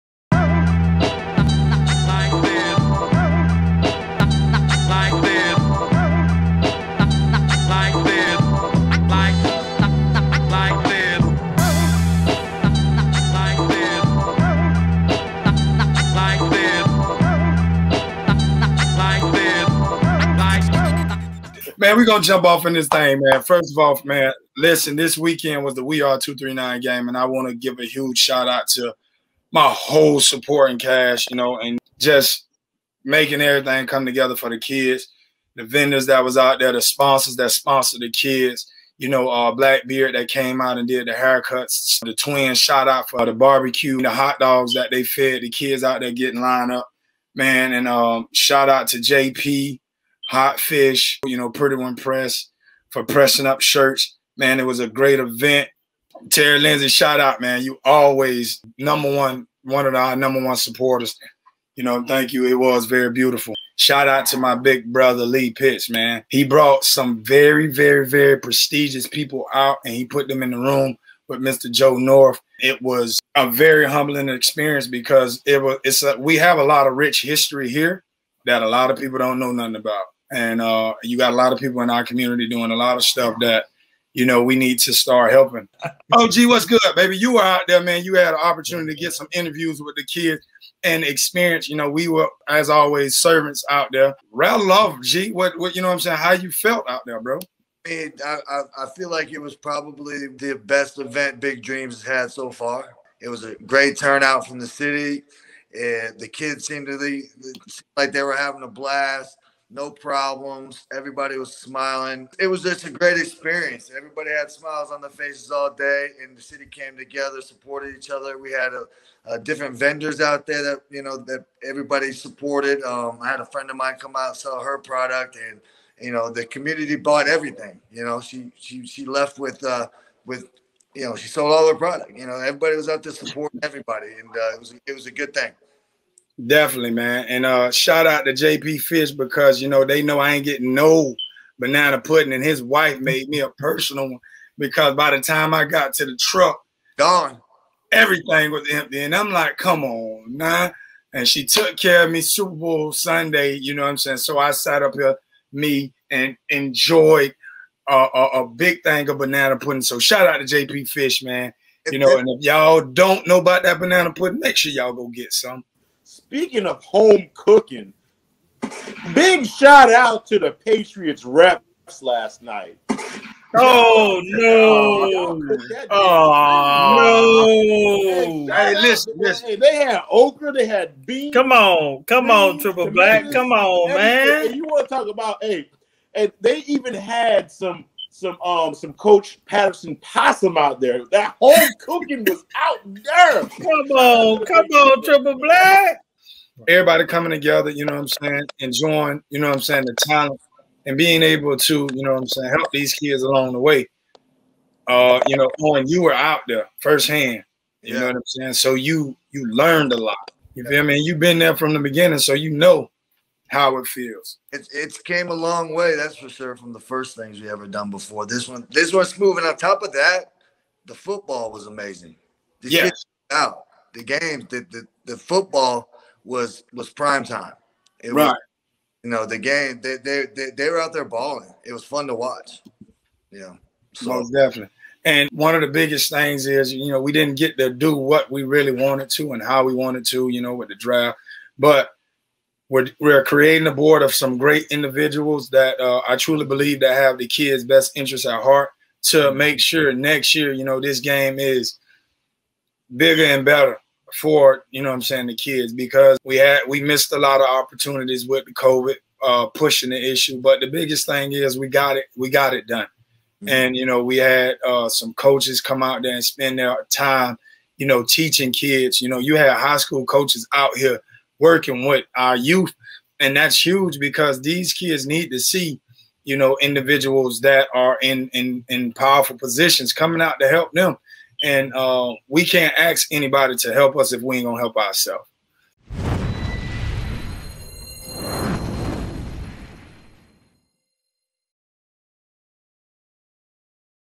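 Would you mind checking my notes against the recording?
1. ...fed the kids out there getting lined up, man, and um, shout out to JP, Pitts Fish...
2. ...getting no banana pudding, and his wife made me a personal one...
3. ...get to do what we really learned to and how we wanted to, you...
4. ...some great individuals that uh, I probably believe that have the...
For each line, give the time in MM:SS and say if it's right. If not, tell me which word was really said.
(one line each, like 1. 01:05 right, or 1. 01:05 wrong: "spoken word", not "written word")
1. 00:45 wrong: "Hot", not "Pitts"
2. 02:20 right
3. 03:57 wrong: "wanted", not "learned"
4. 04:04 wrong: "truly", not "probably".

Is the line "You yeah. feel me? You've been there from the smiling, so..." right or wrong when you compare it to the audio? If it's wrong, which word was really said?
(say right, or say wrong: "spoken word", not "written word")
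wrong: "beginning", not "smiling".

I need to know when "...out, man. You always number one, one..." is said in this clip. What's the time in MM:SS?
00:57.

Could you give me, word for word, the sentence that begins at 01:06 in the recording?
He brought some very, very, very prestigious people out and he put them in the room with Mr.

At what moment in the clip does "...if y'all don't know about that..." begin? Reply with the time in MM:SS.
02:42.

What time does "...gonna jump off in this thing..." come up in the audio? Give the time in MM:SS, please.
00:22.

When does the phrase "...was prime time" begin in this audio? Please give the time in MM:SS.
03:46.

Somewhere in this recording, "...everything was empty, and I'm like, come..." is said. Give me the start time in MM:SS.
02:27.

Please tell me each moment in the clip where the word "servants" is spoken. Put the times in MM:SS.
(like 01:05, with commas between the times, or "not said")
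01:33.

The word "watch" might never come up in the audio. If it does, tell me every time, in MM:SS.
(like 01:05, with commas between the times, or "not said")
03:52.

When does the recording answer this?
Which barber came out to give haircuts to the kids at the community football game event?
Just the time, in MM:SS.
00:39.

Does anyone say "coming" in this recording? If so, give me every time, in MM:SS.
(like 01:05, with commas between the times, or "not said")
03:17, 04:39.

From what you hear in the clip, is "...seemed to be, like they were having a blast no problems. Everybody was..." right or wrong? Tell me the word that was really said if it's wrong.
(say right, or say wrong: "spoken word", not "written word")
right.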